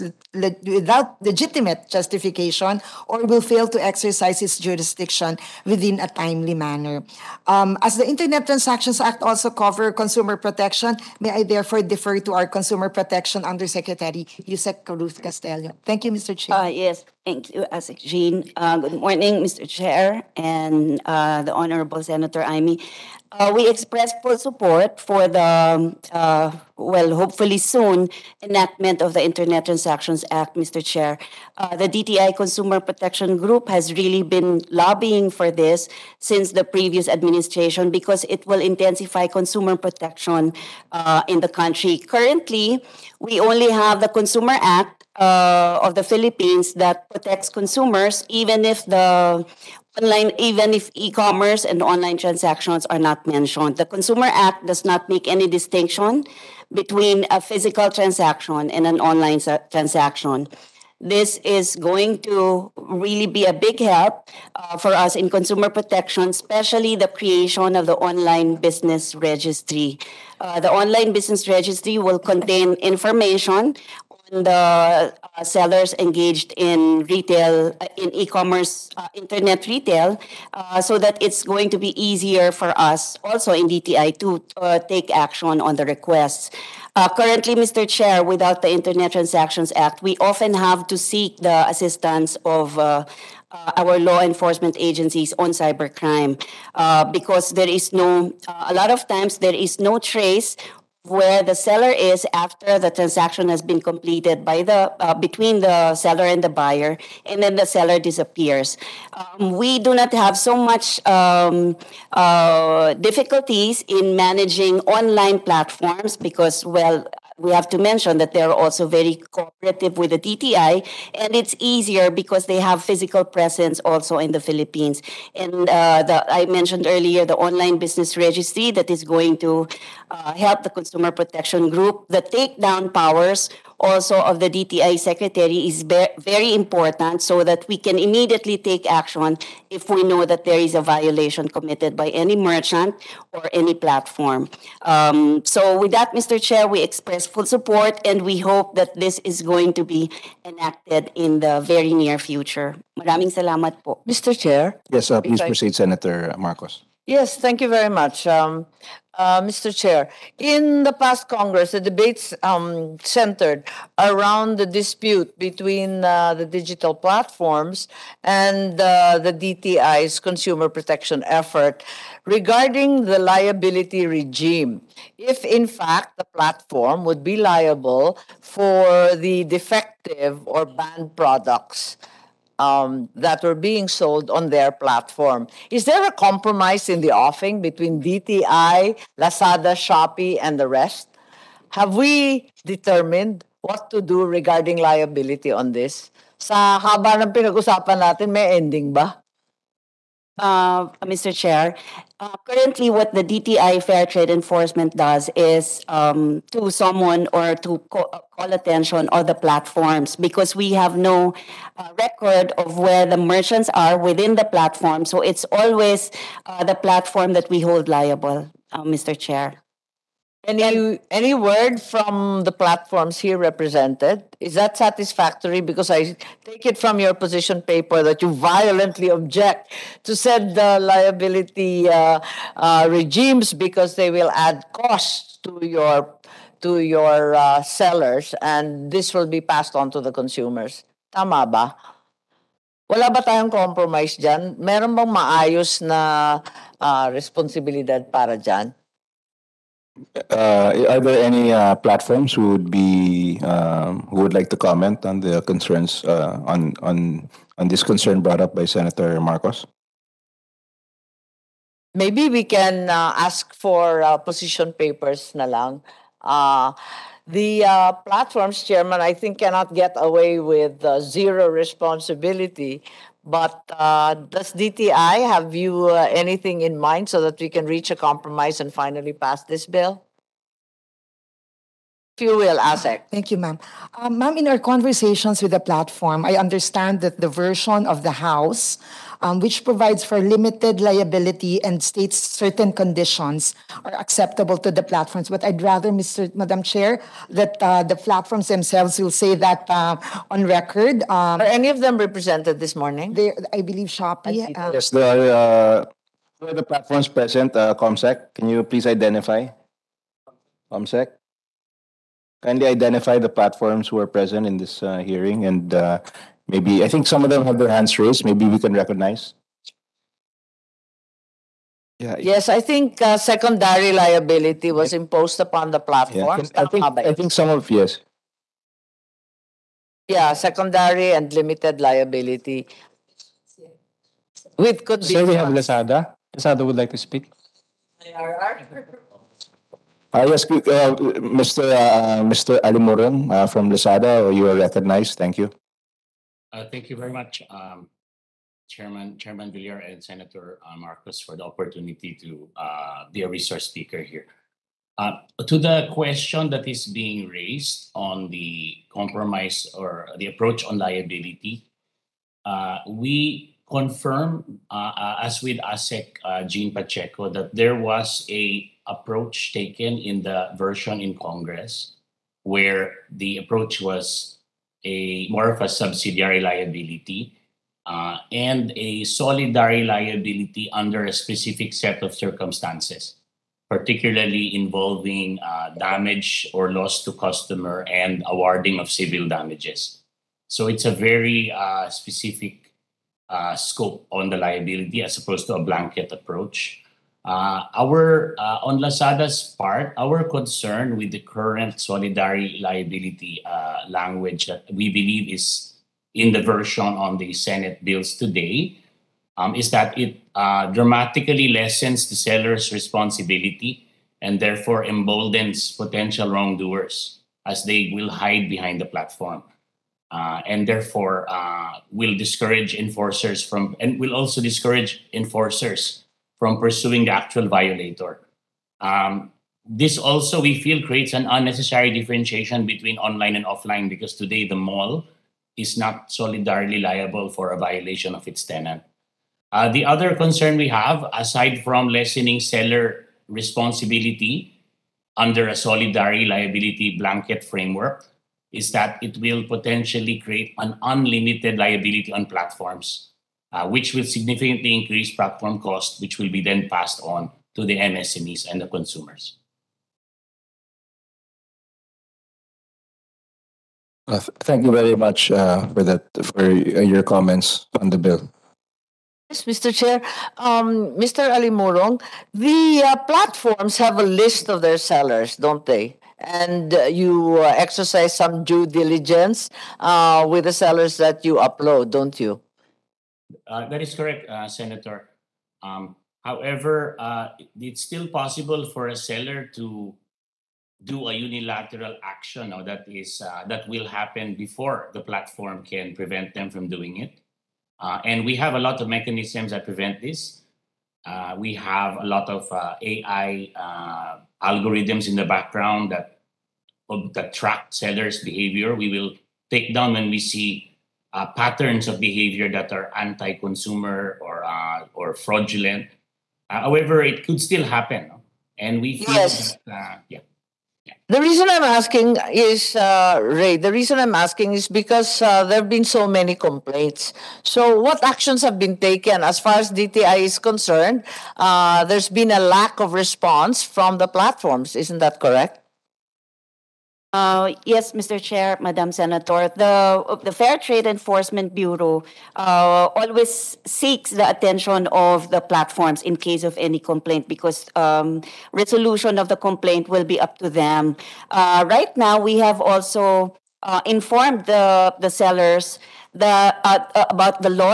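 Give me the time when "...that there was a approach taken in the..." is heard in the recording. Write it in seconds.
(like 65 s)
367 s.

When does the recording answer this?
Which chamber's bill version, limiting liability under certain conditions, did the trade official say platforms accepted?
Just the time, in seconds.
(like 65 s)
287 s.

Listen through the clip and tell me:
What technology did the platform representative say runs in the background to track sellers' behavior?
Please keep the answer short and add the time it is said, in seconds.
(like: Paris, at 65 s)
AI algorithms, at 502 s.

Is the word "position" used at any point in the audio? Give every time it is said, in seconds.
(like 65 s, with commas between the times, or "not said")
227 s, 264 s.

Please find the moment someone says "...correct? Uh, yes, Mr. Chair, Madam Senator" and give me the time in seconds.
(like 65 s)
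535 s.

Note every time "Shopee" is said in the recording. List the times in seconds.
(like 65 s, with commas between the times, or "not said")
189 s, 303 s.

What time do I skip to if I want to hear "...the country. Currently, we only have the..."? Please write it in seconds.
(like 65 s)
41 s.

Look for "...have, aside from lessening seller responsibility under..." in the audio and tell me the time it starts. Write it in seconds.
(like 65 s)
440 s.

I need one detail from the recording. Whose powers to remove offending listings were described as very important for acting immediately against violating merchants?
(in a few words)
DTI secretary.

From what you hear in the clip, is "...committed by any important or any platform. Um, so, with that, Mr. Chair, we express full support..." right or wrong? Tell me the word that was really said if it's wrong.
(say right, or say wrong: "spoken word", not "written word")
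wrong: "merchant", not "important".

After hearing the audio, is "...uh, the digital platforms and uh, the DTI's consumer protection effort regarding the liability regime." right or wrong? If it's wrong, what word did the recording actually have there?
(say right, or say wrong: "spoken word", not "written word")
right.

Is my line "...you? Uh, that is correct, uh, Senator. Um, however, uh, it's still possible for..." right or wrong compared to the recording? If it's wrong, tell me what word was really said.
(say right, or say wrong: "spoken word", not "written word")
right.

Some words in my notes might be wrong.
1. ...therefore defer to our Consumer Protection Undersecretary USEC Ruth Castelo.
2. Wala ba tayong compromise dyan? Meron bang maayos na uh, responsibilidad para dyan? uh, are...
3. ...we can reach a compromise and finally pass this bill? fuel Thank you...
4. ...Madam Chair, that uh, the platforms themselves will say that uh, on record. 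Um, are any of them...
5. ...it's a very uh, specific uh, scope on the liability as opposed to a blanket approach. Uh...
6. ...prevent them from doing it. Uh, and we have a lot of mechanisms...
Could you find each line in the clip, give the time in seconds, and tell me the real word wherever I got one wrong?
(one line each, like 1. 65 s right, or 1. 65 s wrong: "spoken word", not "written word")
1. 11 s right
2. 242 s right
3. 277 s right
4. 296 s right
5. 390 s right
6. 495 s right.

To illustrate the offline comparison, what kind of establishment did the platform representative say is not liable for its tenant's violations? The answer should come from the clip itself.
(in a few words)
the mall.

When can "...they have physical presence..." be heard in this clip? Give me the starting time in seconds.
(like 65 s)
122 s.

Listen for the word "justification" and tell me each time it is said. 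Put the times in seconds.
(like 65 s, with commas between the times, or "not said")
1 s.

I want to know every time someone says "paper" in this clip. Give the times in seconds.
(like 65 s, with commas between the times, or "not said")
227 s, 264 s.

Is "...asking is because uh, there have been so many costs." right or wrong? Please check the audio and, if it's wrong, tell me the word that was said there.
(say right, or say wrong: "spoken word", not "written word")
wrong: "complaints", not "costs".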